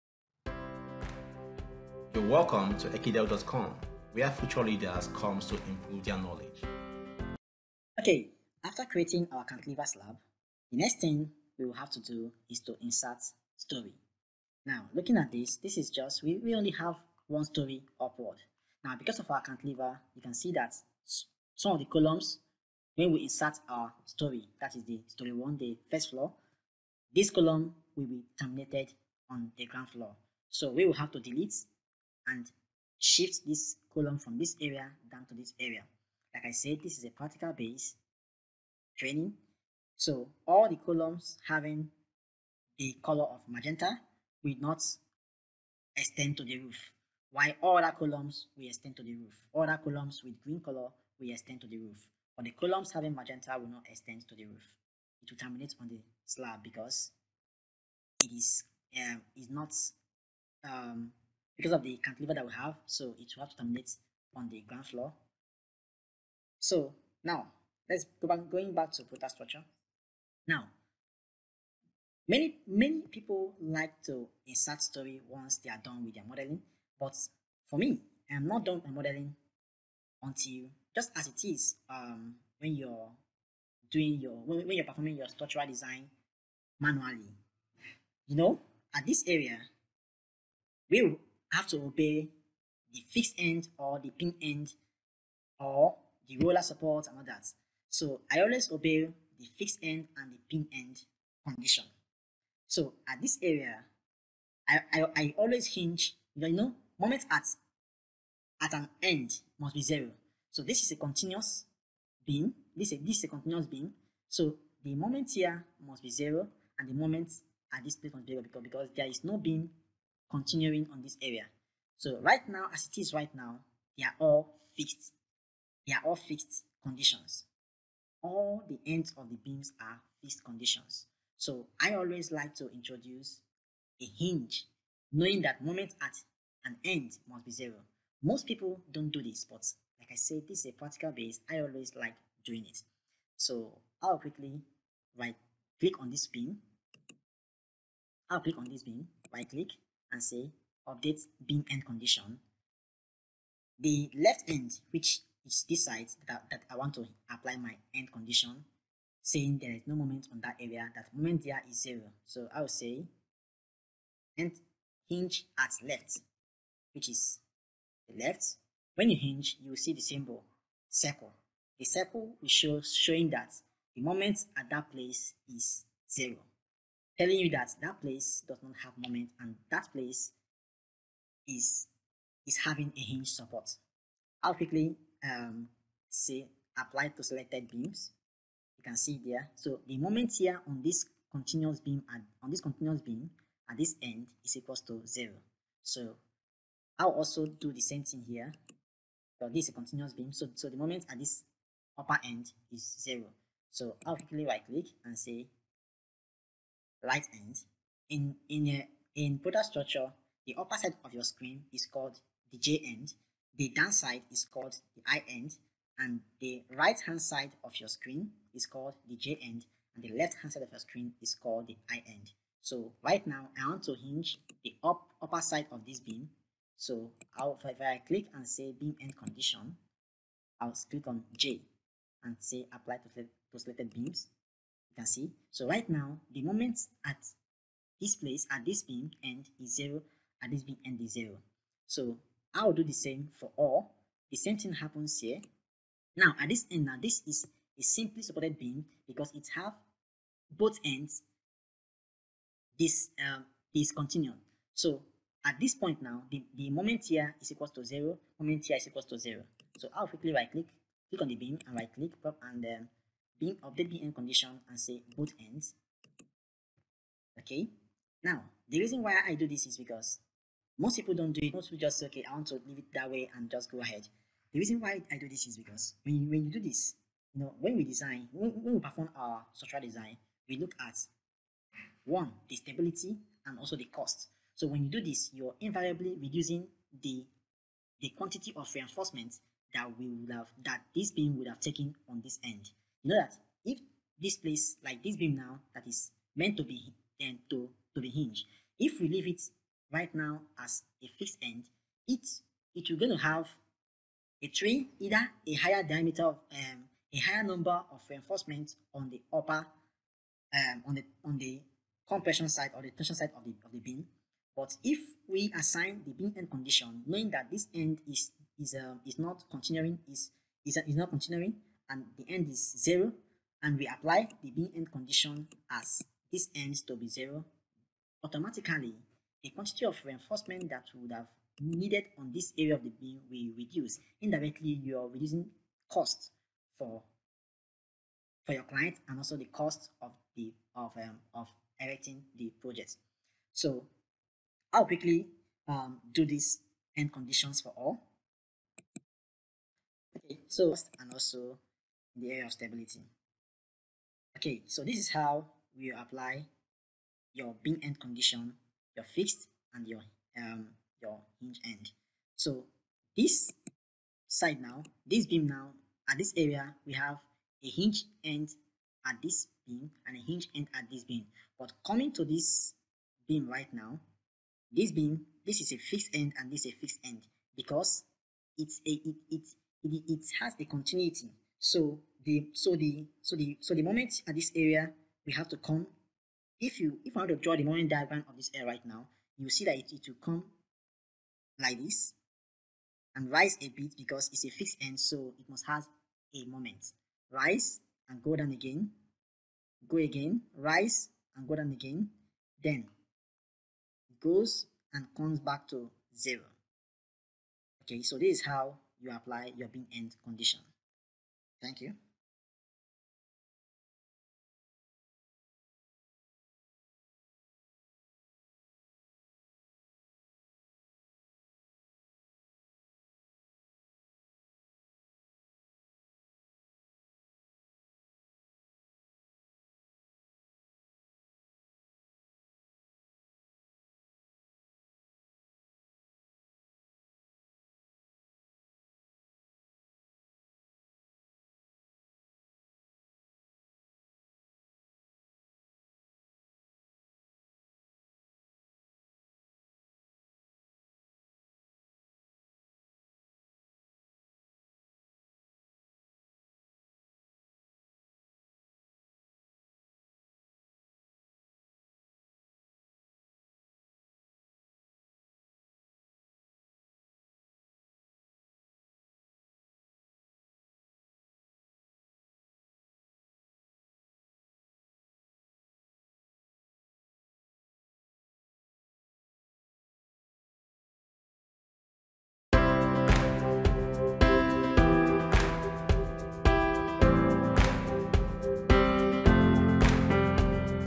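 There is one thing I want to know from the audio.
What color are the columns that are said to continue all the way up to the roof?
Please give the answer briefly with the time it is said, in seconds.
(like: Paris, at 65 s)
green, at 50 s.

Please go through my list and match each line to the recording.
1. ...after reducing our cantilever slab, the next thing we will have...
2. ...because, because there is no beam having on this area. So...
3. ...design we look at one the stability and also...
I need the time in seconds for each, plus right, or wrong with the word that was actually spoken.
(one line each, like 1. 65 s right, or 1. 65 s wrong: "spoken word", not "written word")
1. 8 s wrong: "creating", not "reducing"
2. 118 s wrong: "continuing", not "having"
3. 279 s right.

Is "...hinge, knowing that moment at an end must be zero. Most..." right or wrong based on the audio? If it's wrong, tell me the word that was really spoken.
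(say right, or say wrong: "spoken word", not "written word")
right.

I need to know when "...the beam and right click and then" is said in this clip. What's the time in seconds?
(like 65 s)
261 s.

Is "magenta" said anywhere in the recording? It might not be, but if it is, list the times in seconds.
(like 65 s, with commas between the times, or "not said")
43 s, 53 s.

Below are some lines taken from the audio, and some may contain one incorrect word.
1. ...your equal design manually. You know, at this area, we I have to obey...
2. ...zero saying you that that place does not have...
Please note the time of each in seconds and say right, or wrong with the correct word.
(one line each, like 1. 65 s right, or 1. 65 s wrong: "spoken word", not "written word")
1. 85 s wrong: "structural", not "equal"
2. 176 s wrong: "telling", not "saying".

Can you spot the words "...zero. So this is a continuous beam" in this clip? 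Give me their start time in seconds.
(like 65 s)
109 s.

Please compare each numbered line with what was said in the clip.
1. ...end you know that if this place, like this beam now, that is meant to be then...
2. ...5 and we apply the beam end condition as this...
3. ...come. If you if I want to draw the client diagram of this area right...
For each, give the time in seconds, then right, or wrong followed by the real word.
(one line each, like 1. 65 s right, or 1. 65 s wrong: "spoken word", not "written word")
1. 292 s right
2. 322 s wrong: "0", not "5"
3. 385 s wrong: "moment", not "client".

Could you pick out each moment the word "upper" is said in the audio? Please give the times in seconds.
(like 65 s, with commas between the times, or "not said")
201 s, 210 s, 225 s, 309 s.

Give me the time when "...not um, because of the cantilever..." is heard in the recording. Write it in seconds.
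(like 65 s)
59 s.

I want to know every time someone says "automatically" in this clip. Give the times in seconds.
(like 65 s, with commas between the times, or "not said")
328 s.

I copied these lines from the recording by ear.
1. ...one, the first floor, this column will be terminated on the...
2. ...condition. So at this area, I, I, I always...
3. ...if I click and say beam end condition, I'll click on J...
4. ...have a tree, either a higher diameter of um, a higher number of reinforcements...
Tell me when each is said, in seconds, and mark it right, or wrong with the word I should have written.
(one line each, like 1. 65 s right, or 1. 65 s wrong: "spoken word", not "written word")
1. 25 s right
2. 101 s right
3. 227 s right
4. 303 s right.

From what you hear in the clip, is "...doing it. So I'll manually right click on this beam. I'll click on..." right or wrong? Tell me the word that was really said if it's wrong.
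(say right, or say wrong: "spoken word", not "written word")
wrong: "quickly", not "manually".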